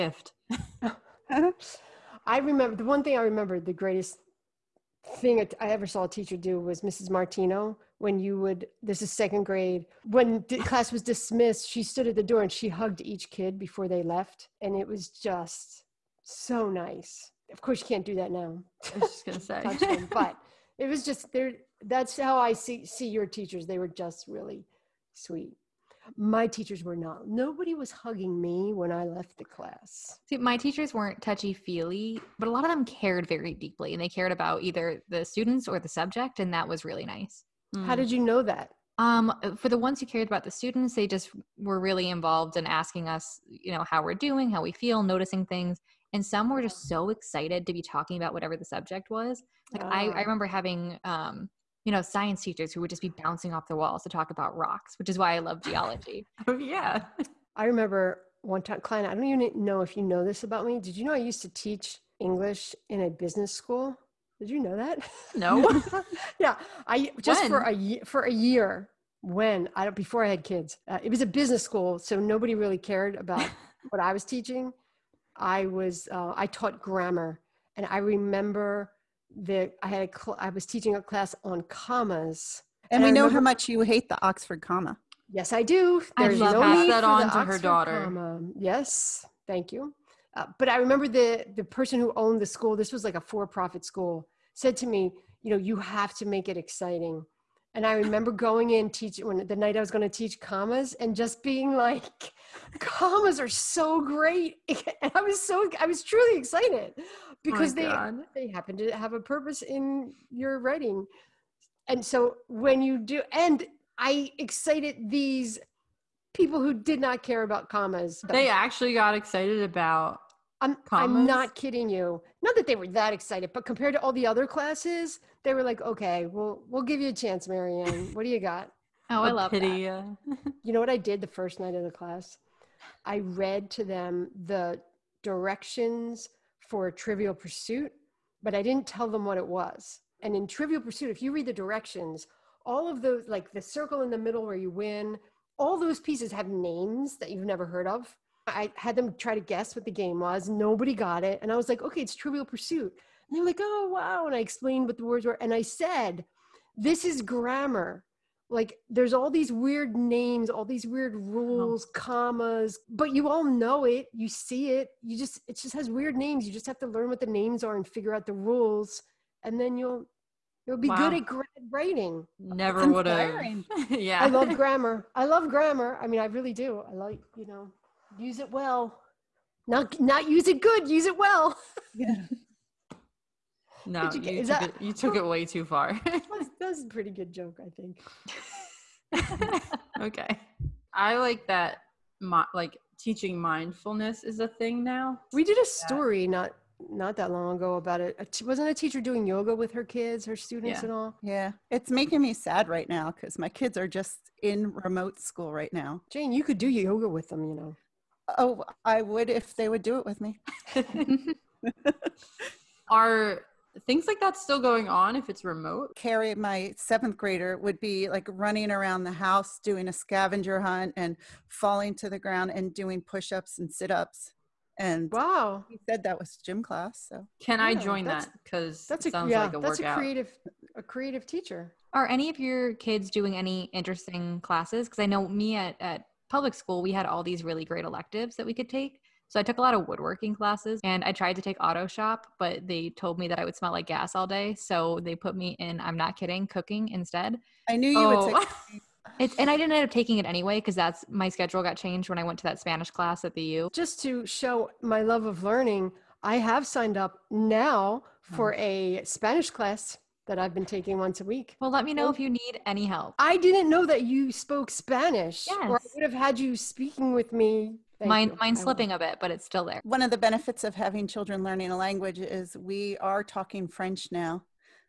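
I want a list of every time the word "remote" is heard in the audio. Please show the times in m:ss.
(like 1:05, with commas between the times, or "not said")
3:24, 3:35.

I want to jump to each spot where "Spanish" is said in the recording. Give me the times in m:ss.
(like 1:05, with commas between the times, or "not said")
4:12, 4:19, 4:24.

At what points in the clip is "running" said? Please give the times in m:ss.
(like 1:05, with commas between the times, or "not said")
3:38.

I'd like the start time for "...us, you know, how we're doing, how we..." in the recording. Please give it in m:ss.
0:43.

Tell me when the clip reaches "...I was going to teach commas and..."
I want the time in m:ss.
1:39.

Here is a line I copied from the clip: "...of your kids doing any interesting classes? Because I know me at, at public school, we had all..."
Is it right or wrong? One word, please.
right.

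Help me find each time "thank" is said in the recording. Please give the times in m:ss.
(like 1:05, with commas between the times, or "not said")
1:29, 4:27.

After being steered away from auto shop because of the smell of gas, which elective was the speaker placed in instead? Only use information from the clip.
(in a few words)
Cooking.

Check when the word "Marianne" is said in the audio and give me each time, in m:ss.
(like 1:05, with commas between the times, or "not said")
2:07.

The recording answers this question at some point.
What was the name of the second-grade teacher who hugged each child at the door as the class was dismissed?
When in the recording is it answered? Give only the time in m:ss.
0:06.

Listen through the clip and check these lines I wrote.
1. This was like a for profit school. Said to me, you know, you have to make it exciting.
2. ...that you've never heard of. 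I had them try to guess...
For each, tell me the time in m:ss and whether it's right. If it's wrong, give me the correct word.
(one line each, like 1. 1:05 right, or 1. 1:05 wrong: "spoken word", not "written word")
1. 1:32 right
2. 2:27 right.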